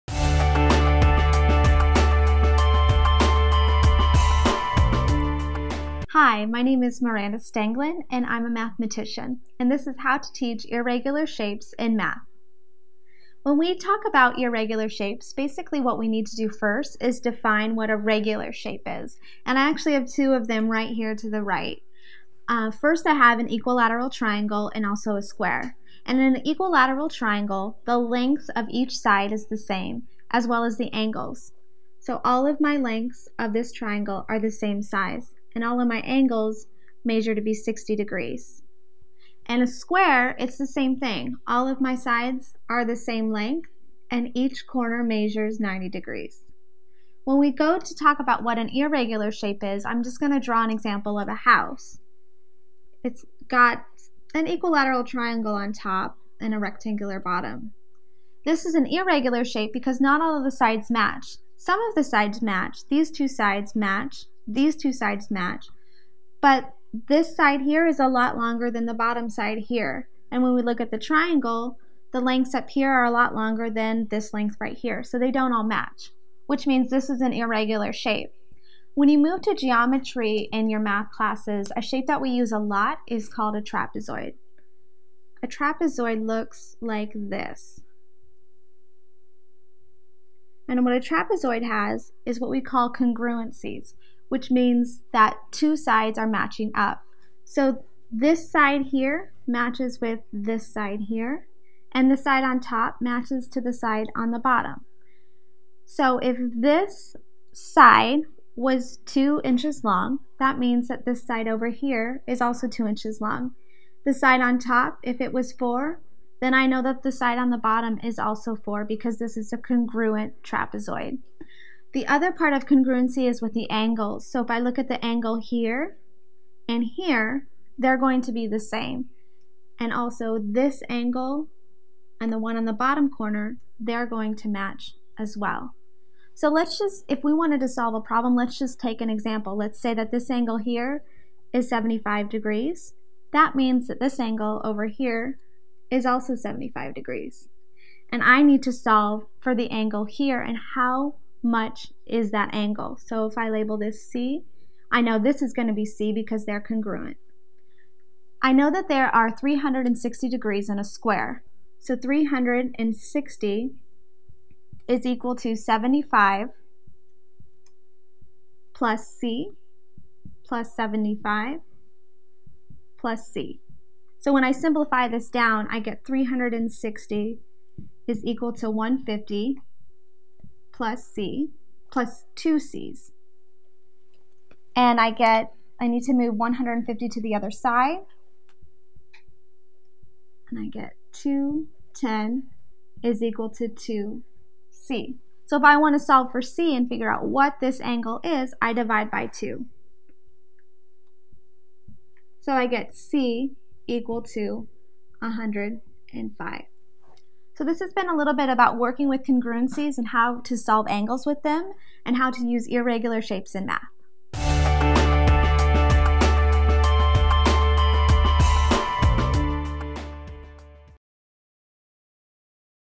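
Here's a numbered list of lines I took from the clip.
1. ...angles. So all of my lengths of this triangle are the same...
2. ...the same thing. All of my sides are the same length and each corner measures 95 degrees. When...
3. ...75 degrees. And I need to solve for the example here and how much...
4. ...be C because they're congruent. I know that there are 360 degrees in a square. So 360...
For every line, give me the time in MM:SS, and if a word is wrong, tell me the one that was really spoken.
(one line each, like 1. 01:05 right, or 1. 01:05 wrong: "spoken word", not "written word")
1. 00:30 right
2. 00:40 wrong: "90", not "95"
3. 02:26 wrong: "angle", not "example"
4. 02:35 right.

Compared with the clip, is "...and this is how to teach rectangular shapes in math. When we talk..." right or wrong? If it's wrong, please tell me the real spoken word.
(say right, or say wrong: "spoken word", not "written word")
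wrong: "irregular", not "rectangular".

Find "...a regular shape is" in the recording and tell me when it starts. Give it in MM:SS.
00:17.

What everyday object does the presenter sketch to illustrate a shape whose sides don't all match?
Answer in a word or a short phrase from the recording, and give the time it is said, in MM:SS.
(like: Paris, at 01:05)
a house, at 00:50.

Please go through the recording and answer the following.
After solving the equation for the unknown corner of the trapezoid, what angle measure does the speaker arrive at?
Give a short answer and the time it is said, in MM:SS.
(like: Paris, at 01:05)
105, at 03:25.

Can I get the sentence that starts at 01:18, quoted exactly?
When you move to geometry in your math classes, a shape that we use a lot is called a trapezoid.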